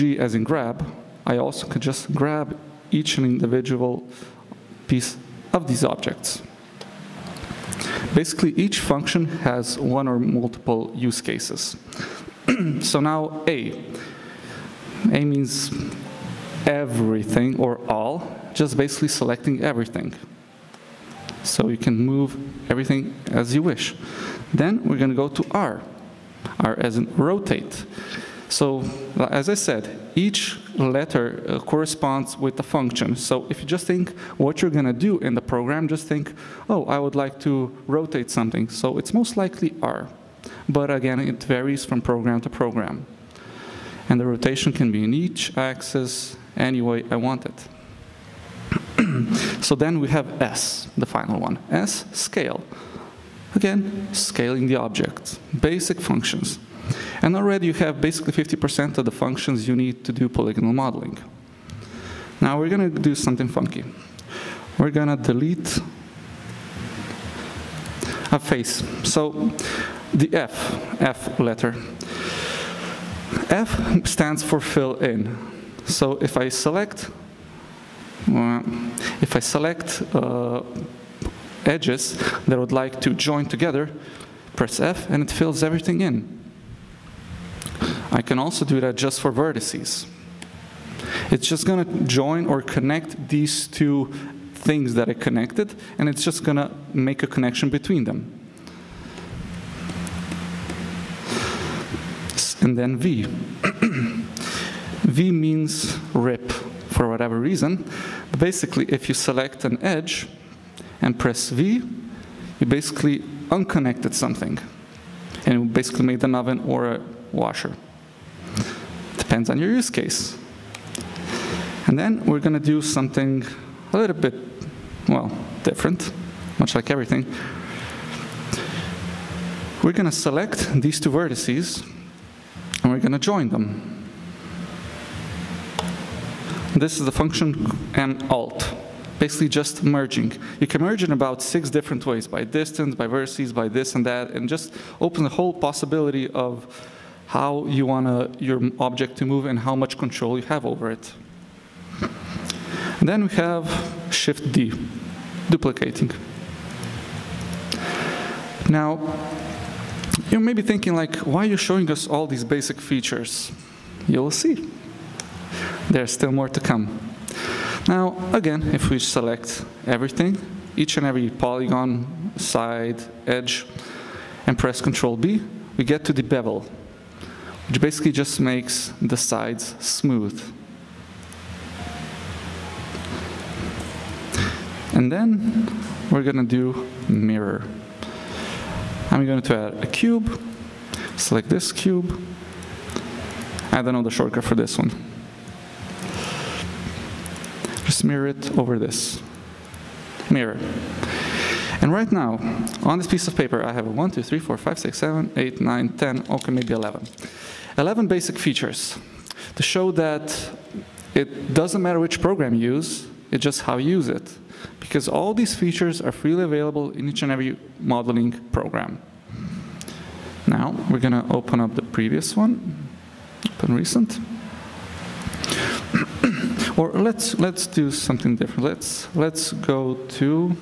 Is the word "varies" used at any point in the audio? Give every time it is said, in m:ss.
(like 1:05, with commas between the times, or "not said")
0:41.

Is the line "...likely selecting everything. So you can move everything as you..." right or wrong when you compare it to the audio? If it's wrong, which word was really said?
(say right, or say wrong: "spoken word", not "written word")
wrong: "basically", not "likely".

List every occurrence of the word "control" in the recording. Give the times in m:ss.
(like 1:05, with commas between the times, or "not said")
2:29, 2:54.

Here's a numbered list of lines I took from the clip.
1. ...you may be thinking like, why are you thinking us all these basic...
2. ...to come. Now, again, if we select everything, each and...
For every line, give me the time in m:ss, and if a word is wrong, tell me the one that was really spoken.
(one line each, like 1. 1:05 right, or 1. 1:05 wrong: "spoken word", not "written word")
1. 2:40 wrong: "showing", not "thinking"
2. 2:46 right.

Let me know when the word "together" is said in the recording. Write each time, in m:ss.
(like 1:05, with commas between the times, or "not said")
1:23.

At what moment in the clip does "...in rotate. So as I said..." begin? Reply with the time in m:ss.
0:26.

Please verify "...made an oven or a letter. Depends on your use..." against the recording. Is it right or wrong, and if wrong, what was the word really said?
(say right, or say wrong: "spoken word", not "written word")
wrong: "washer", not "letter".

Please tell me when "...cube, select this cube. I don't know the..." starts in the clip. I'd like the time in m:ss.
3:09.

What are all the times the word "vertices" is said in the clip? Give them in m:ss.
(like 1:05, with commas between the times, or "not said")
1:29, 2:11, 2:23.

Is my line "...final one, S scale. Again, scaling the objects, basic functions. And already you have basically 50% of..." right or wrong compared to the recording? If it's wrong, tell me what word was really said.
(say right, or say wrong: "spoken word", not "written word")
right.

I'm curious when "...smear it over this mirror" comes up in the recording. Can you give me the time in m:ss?
3:17.